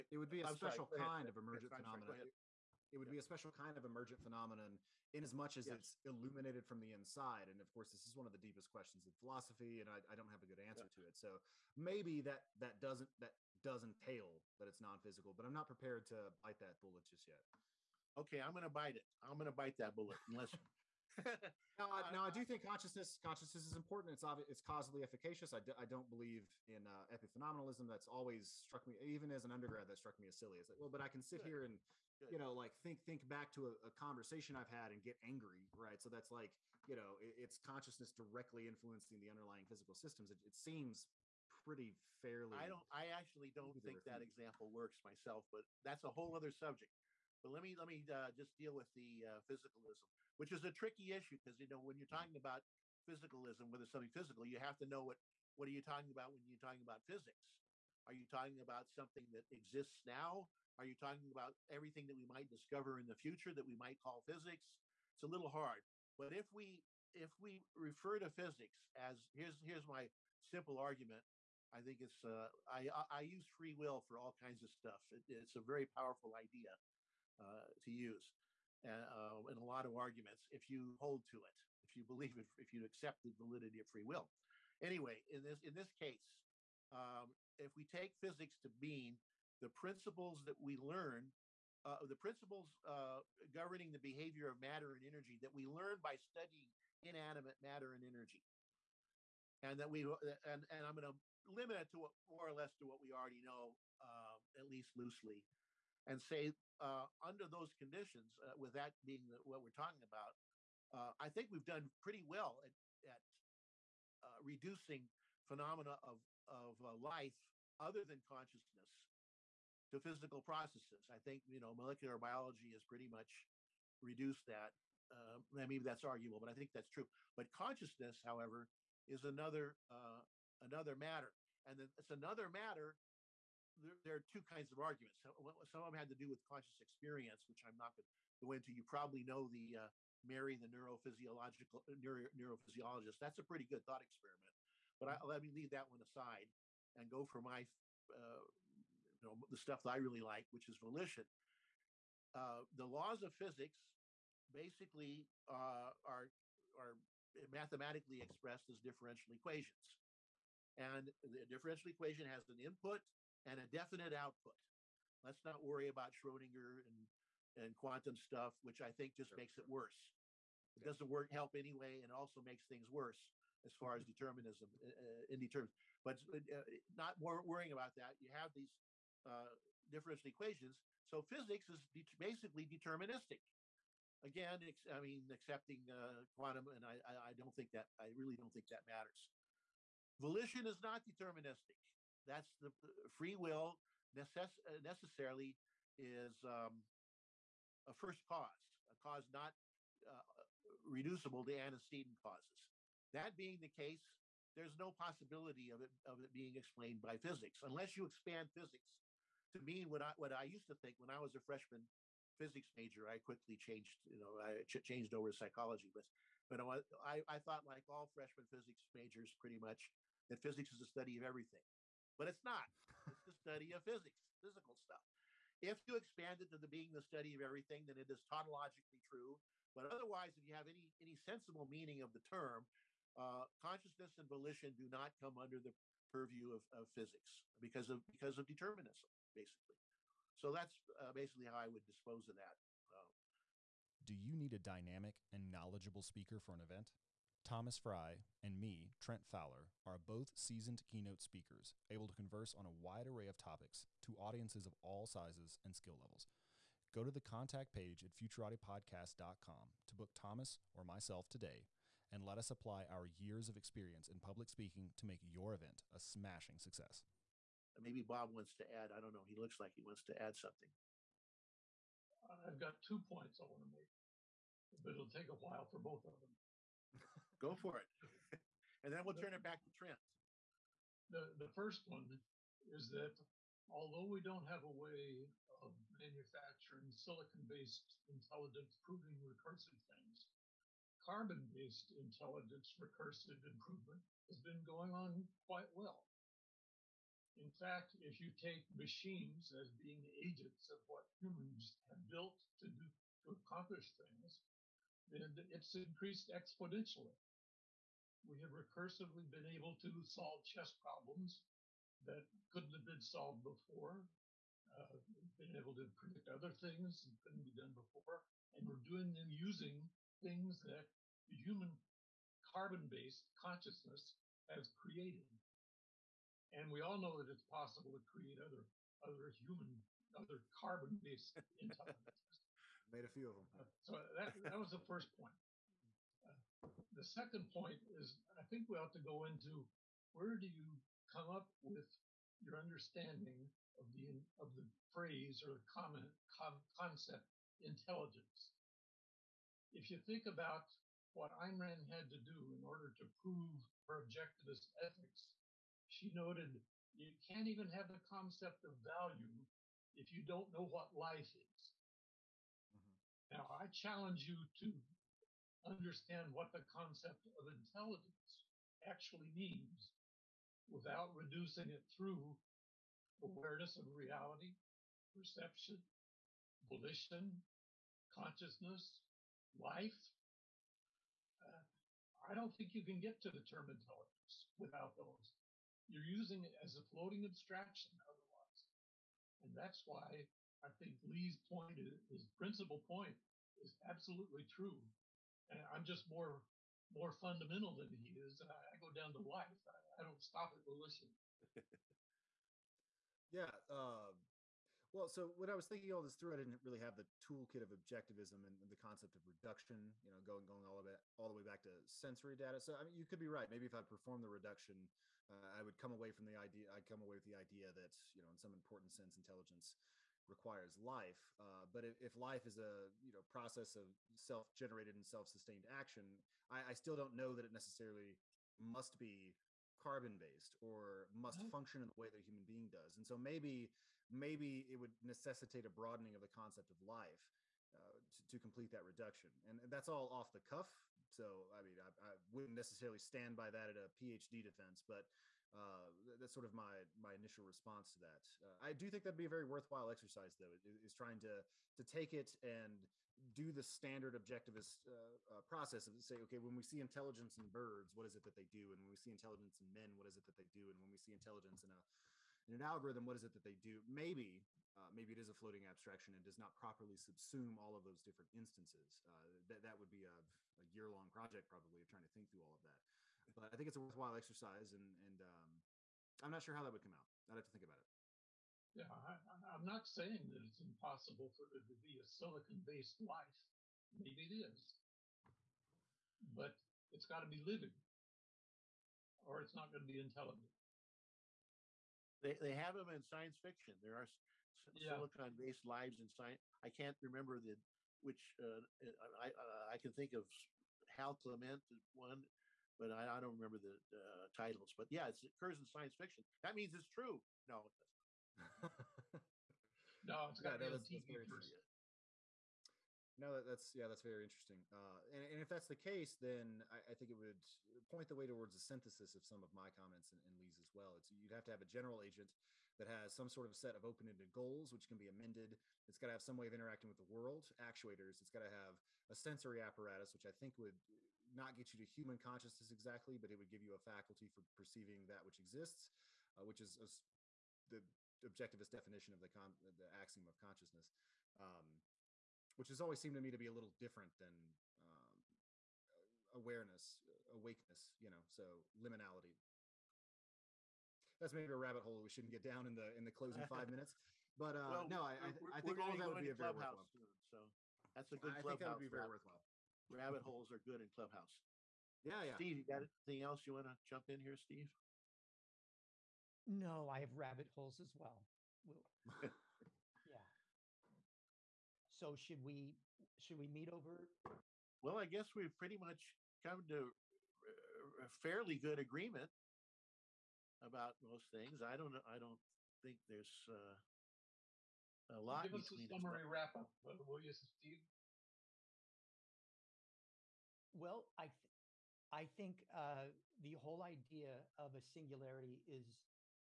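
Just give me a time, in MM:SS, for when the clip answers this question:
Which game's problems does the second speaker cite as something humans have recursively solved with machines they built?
05:10.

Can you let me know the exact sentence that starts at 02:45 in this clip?
Let's not worry about Schrodinger and, and quantum stuff, which I think just sure.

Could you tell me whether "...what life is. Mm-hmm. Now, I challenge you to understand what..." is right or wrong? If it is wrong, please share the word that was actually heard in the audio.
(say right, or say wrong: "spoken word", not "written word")
right.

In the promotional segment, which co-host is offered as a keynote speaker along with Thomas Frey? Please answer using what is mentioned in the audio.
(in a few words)
Trent Fowler.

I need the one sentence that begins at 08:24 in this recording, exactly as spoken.
But yeah, it occurs in science fiction.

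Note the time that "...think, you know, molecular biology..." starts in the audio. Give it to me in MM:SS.
02:01.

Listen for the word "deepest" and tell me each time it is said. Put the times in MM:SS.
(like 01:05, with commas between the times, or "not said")
00:08.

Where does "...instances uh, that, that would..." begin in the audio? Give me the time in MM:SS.
07:48.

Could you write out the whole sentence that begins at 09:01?
Um, which has always seemed to me to be a little different than um, awareness, awakeness, you know, so liminality.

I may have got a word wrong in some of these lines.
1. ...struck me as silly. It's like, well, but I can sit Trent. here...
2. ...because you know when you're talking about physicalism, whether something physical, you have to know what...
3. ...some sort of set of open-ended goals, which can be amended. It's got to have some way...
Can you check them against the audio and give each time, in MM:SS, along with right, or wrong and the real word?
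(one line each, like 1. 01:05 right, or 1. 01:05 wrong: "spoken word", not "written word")
1. 00:29 wrong: "Good", not "Trent"
2. 00:51 right
3. 08:43 right.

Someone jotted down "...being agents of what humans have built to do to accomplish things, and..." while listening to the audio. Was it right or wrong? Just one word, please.
right.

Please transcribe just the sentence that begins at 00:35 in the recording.
So that's like you know, it, it's consciousness directly influencing the underlying physical systems.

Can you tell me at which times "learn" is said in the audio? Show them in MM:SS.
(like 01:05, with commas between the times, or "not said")
01:30, 01:35.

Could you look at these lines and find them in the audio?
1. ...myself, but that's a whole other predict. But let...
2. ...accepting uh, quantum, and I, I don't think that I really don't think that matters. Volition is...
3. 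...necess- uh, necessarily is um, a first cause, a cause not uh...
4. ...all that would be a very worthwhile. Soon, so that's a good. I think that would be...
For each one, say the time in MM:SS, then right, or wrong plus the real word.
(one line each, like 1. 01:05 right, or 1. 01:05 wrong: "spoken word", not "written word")
1. 00:45 wrong: "subject", not "predict"
2. 03:05 right
3. 03:14 right
4. 09:15 right.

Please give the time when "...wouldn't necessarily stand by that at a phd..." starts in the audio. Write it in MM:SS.
07:22.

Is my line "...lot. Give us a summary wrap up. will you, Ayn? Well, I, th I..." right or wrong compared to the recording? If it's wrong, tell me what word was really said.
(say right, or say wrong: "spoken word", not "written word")
wrong: "Steve", not "Ayn".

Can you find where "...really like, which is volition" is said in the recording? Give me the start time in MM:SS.
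02:29.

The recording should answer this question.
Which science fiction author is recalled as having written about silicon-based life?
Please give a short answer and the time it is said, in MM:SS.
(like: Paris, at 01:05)
Hal Clement, at 08:20.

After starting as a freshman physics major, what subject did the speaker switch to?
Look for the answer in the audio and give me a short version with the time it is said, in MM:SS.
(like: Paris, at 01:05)
psychology, at 03:35.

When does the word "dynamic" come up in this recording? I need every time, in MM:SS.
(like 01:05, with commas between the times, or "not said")
04:04.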